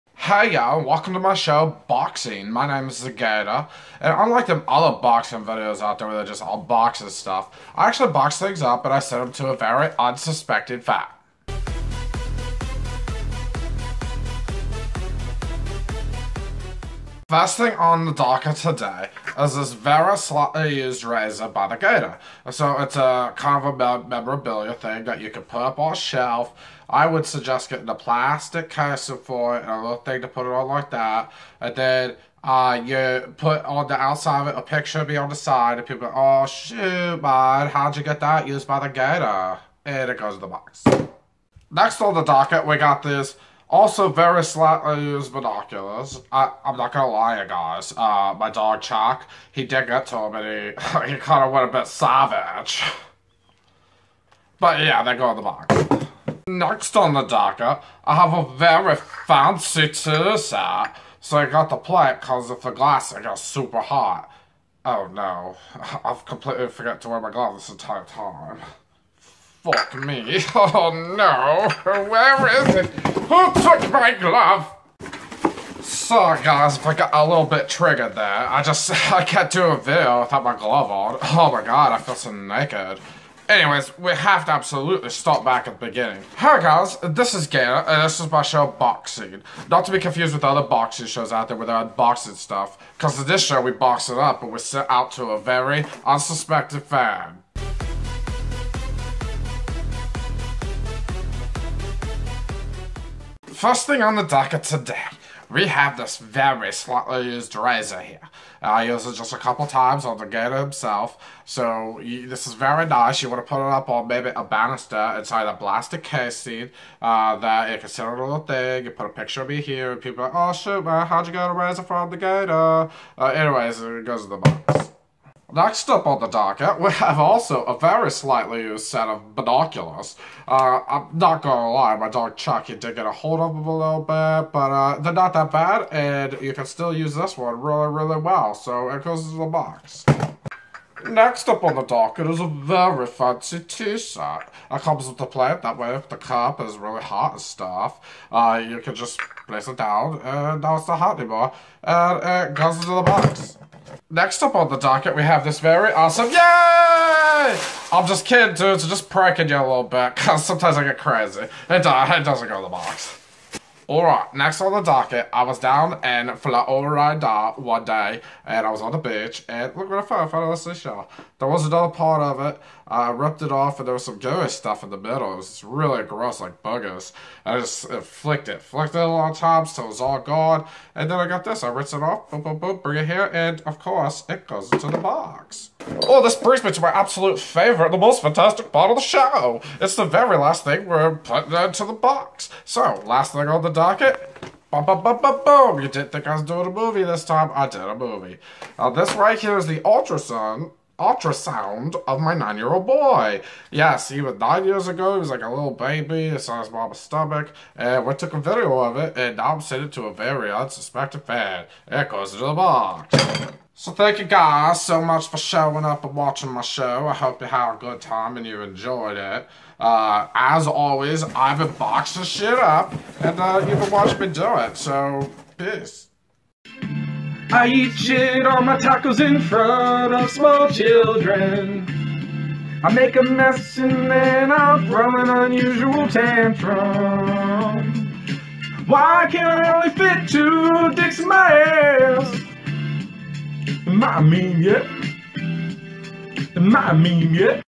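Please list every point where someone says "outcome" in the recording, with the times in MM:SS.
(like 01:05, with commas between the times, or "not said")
not said.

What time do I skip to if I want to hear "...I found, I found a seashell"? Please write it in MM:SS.
02:49.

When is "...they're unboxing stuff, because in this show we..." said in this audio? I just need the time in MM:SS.
01:31.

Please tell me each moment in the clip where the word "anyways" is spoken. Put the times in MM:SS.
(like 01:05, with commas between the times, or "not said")
01:23, 02:03.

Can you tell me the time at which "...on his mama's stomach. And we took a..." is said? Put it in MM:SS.
03:26.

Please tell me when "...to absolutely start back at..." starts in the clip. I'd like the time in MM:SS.
01:24.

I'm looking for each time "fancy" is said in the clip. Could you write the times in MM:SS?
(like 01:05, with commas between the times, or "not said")
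00:58, 02:23.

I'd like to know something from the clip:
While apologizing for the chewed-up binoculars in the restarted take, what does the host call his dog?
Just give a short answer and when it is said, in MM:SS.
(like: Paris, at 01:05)
Chucky, at 02:12.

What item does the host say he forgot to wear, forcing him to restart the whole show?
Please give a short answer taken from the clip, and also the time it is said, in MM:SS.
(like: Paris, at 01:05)
gloves, at 01:07.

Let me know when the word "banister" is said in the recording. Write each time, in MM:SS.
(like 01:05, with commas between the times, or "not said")
01:54.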